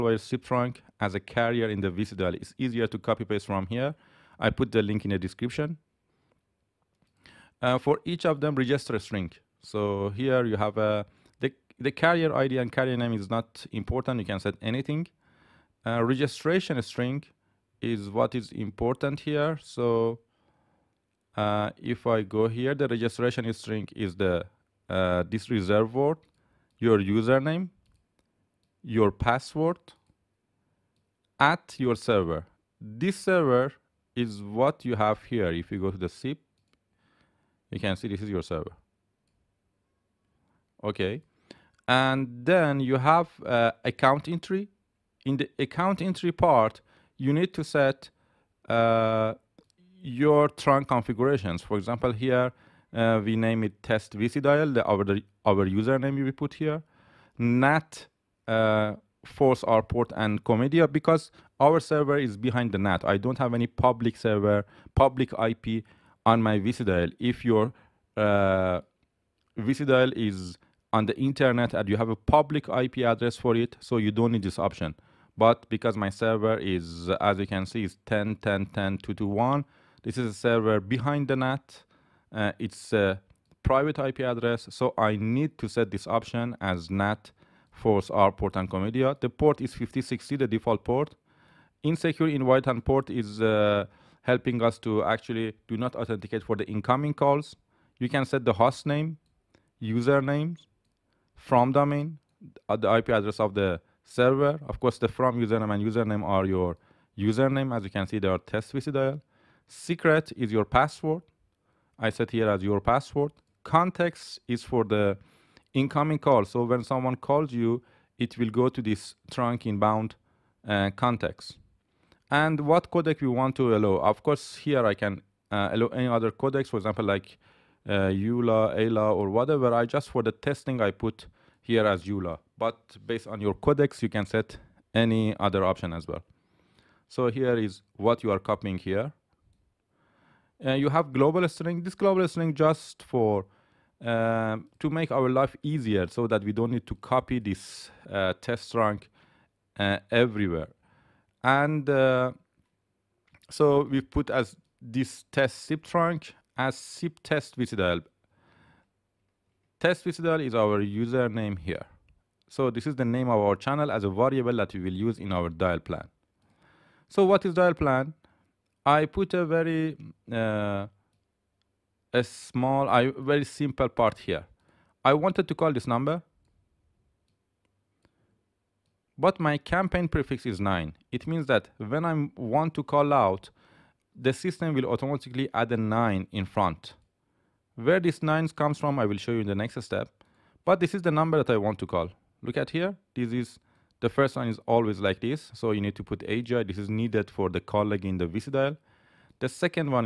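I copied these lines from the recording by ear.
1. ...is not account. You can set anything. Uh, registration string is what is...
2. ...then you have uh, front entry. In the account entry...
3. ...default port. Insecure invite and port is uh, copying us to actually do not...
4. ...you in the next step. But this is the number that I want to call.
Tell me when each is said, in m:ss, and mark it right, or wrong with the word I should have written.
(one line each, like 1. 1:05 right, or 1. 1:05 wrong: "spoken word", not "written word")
1. 0:13 wrong: "important", not "account"
2. 0:42 wrong: "account", not "front"
3. 1:30 wrong: "helping", not "copying"
4. 3:09 right.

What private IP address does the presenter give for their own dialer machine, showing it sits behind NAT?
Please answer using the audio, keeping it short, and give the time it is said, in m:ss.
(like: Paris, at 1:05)
10.10.10.221, at 1:18.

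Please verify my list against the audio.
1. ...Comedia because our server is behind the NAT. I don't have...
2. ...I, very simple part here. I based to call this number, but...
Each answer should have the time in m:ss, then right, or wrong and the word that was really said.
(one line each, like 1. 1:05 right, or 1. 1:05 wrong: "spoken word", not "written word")
1. 1:00 right
2. 2:52 wrong: "wanted", not "based".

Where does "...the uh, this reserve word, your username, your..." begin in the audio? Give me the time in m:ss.
0:24.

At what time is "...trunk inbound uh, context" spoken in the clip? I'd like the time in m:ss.
1:59.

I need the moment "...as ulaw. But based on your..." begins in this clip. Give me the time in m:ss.
2:11.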